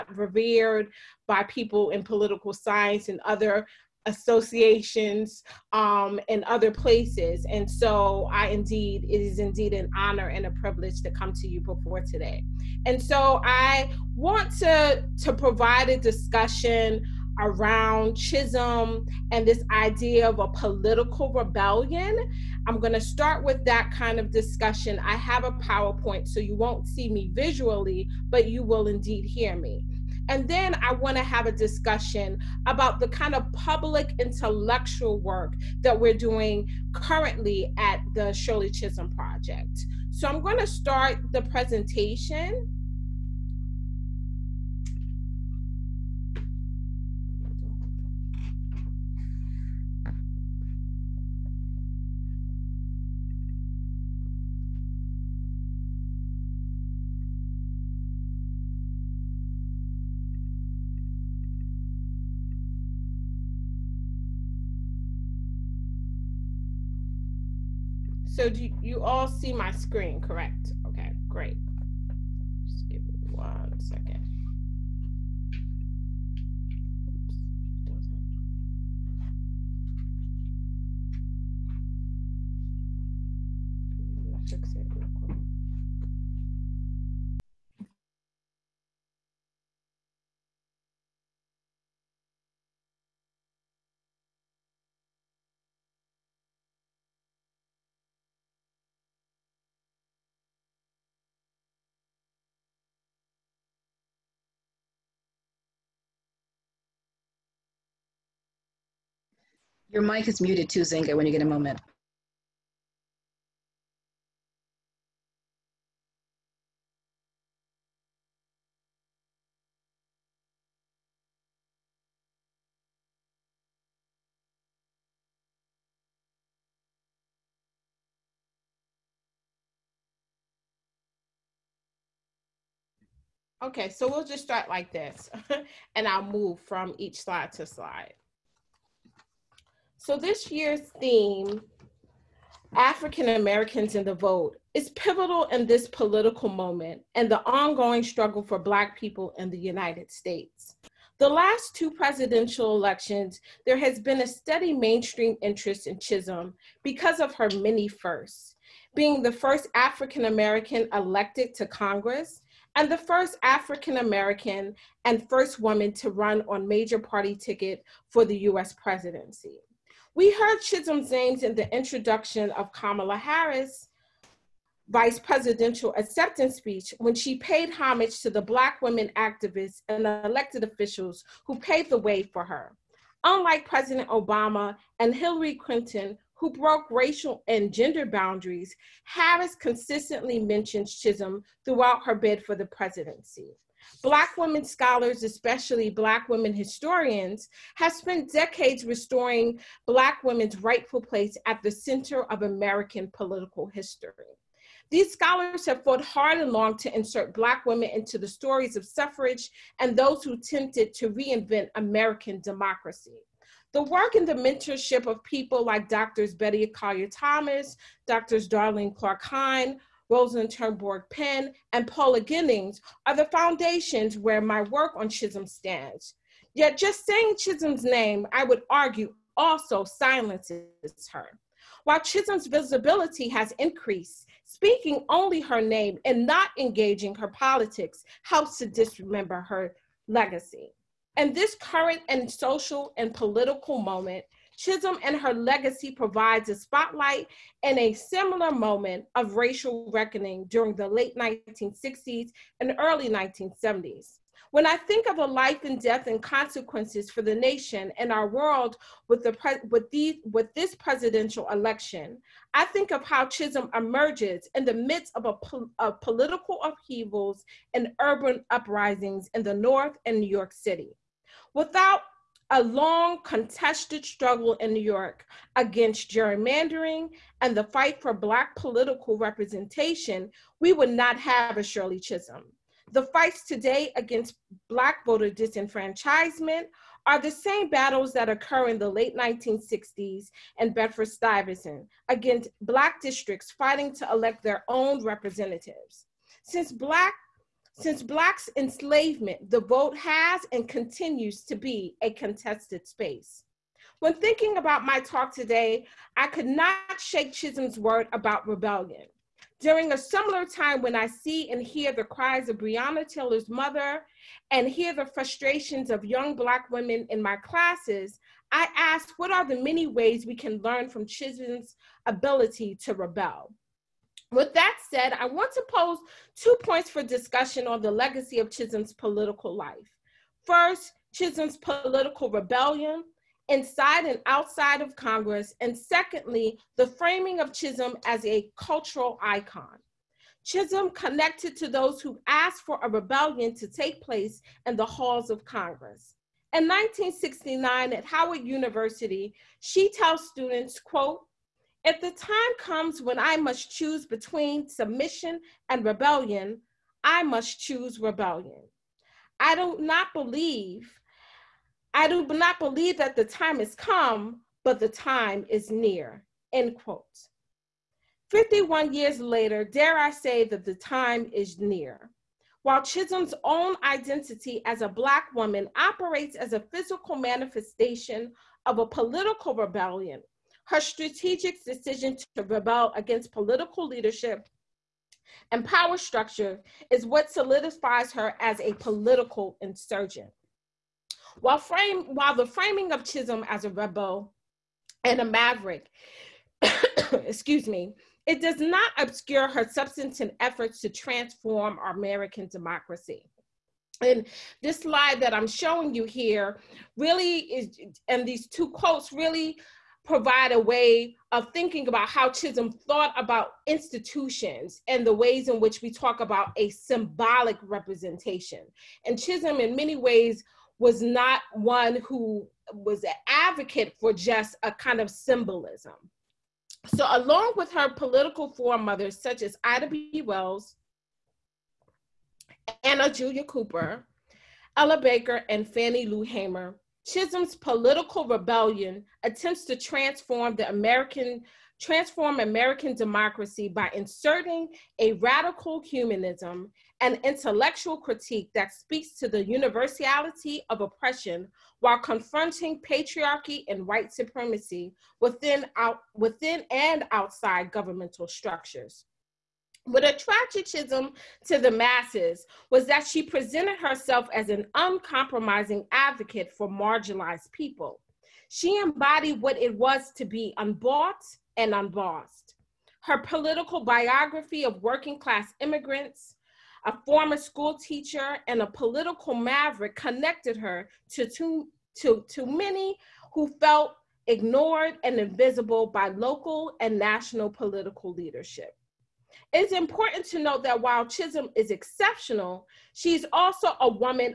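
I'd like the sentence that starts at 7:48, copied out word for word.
She embodied what it was to be unbought and unbossed.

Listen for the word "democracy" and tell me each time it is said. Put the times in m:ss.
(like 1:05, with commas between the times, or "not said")
3:32, 6:42, 7:22.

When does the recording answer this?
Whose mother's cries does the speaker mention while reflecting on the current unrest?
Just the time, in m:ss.
5:12.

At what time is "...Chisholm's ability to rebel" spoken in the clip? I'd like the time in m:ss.
5:21.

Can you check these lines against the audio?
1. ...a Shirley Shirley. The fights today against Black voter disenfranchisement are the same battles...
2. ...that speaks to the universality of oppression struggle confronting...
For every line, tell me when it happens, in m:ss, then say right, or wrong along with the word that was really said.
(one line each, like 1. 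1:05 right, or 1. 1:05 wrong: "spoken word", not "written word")
1. 4:41 wrong: "Chisholm", not "Shirley"
2. 7:28 wrong: "while", not "struggle".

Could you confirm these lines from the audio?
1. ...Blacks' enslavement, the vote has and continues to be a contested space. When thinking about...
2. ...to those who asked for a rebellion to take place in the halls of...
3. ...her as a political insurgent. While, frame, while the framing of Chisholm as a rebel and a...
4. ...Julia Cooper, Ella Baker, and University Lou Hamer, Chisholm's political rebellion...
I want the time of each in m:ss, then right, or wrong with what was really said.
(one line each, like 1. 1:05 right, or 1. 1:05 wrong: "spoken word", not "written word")
1. 4:58 right
2. 5:41 right
3. 6:28 right
4. 7:13 wrong: "Fannie", not "University".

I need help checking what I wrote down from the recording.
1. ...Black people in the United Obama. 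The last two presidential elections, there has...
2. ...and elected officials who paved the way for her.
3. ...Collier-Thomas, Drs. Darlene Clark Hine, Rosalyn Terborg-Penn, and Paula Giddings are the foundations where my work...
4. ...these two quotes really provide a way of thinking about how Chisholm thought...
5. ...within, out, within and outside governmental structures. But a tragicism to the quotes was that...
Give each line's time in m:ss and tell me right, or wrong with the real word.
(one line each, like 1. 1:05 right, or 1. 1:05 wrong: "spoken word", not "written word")
1. 2:28 wrong: "States", not "Obama"
2. 2:59 right
3. 3:36 right
4. 6:48 right
5. 7:35 wrong: "masses", not "quotes".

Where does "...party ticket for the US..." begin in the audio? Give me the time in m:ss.
2:46.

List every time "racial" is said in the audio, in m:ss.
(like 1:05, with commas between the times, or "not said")
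3:06, 4:09.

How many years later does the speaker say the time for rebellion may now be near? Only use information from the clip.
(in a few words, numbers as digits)
51.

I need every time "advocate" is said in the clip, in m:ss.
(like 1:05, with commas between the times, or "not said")
7:03, 7:45.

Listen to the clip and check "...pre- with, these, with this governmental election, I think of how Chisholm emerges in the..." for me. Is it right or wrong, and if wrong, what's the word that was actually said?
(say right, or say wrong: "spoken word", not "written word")
wrong: "presidential", not "governmental".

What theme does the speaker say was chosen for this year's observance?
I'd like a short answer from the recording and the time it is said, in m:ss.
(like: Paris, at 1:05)
African Americans in the Vote, at 2:22.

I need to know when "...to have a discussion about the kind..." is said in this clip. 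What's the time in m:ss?
0:31.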